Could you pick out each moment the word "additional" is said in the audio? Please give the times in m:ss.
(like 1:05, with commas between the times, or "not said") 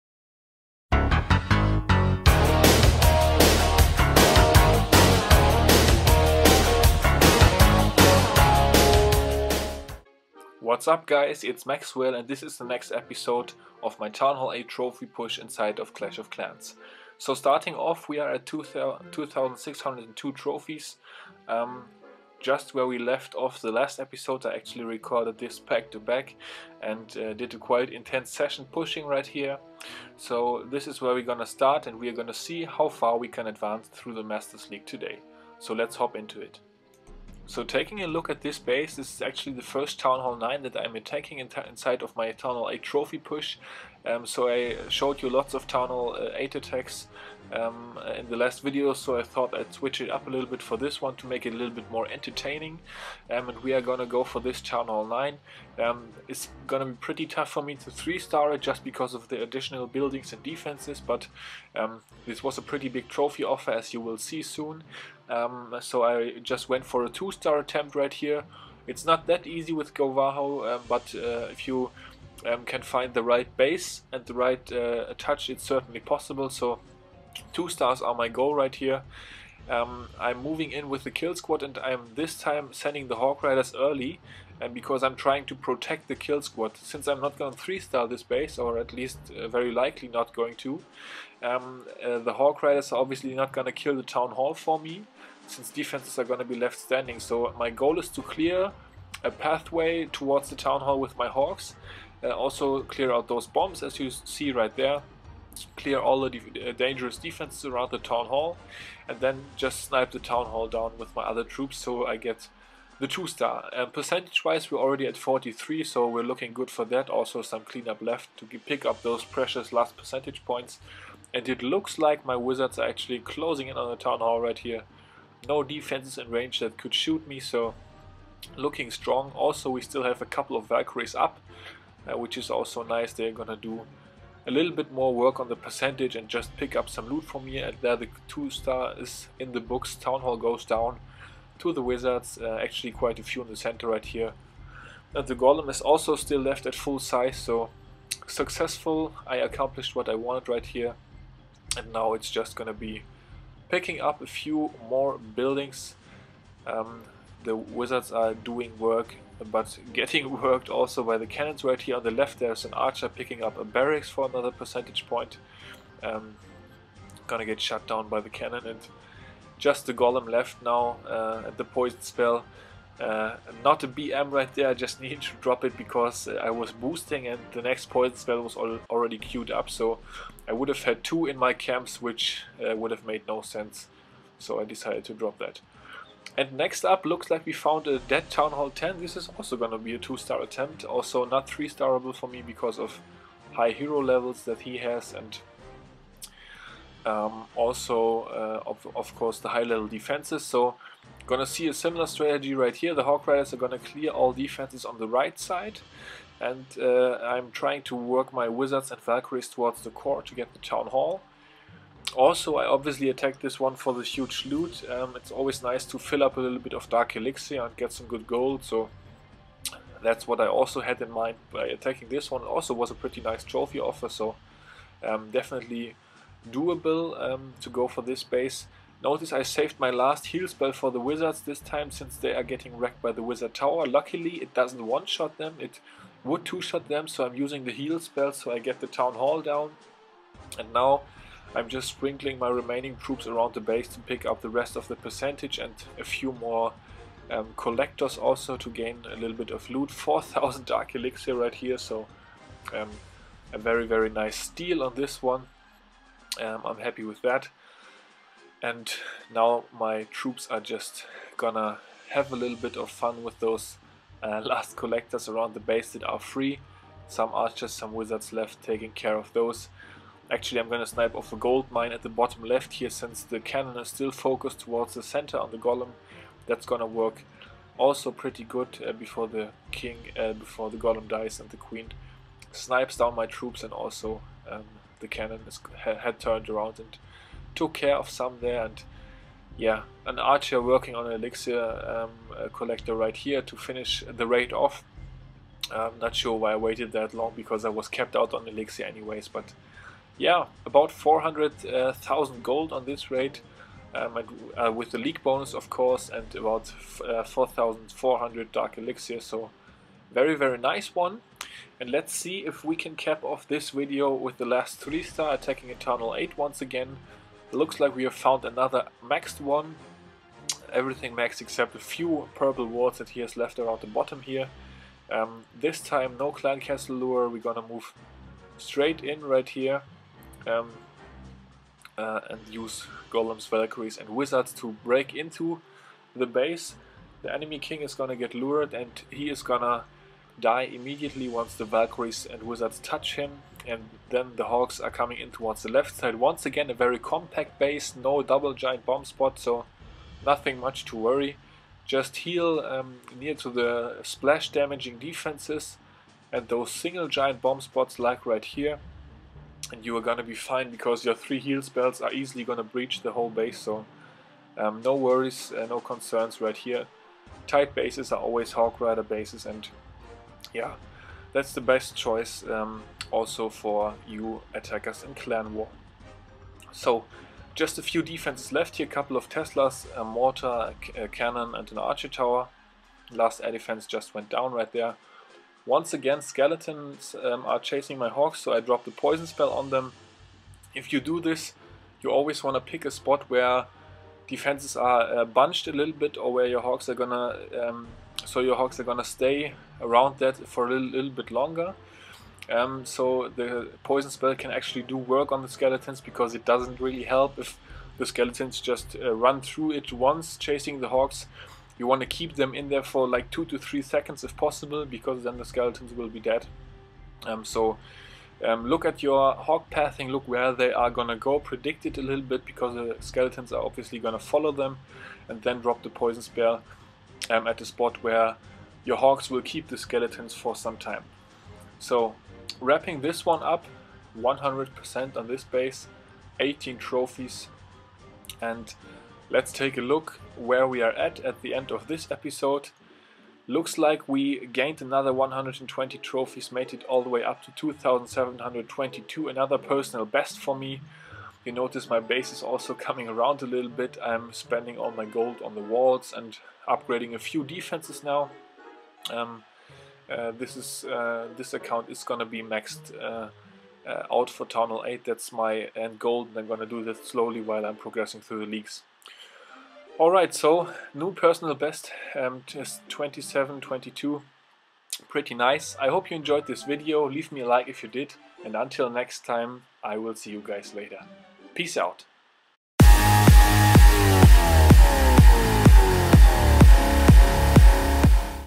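0:59.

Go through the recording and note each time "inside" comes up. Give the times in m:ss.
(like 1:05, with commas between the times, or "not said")
0:15, 0:41.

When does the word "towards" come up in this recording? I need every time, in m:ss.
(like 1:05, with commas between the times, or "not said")
1:40, 3:29, 4:34, 5:45.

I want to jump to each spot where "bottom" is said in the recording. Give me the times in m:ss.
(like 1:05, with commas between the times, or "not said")
4:32, 5:23.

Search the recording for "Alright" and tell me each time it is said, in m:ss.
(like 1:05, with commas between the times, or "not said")
7:50.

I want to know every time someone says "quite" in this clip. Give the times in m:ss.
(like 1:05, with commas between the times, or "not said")
0:27, 2:22.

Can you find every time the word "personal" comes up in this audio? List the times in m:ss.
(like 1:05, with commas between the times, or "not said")
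7:29, 7:51.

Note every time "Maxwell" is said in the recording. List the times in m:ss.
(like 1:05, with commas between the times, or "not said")
0:11.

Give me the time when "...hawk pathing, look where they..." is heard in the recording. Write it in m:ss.
6:59.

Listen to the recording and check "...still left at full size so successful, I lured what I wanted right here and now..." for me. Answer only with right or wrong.
wrong.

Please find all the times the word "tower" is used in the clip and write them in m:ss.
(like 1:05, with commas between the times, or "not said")
3:53, 6:22.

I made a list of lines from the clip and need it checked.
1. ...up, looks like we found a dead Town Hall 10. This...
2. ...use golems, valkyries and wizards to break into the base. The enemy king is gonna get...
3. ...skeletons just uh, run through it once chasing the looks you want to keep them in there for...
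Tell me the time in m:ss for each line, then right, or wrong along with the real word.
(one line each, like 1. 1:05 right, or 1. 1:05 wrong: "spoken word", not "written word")
1. 3:06 right
2. 5:32 right
3. 6:48 wrong: "hawks", not "looks".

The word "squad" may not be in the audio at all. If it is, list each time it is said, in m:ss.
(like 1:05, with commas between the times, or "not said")
1:21, 1:26.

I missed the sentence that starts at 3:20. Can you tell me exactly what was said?
So, gonna see a similar strategy right here.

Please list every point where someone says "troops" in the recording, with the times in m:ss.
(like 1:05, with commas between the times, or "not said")
1:51, 4:02, 4:20, 4:43.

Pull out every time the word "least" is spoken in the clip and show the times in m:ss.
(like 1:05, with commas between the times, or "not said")
1:28.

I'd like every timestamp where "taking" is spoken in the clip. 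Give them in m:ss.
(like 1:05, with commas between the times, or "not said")
0:37, 4:28.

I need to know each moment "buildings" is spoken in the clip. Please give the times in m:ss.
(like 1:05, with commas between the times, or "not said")
0:59, 2:35.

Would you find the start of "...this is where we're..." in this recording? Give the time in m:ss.
0:30.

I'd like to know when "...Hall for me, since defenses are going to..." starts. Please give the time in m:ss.
1:34.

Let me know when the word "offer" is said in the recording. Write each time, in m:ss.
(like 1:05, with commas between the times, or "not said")
1:03, 3:43.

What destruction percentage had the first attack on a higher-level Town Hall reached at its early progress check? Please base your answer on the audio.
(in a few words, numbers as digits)
43.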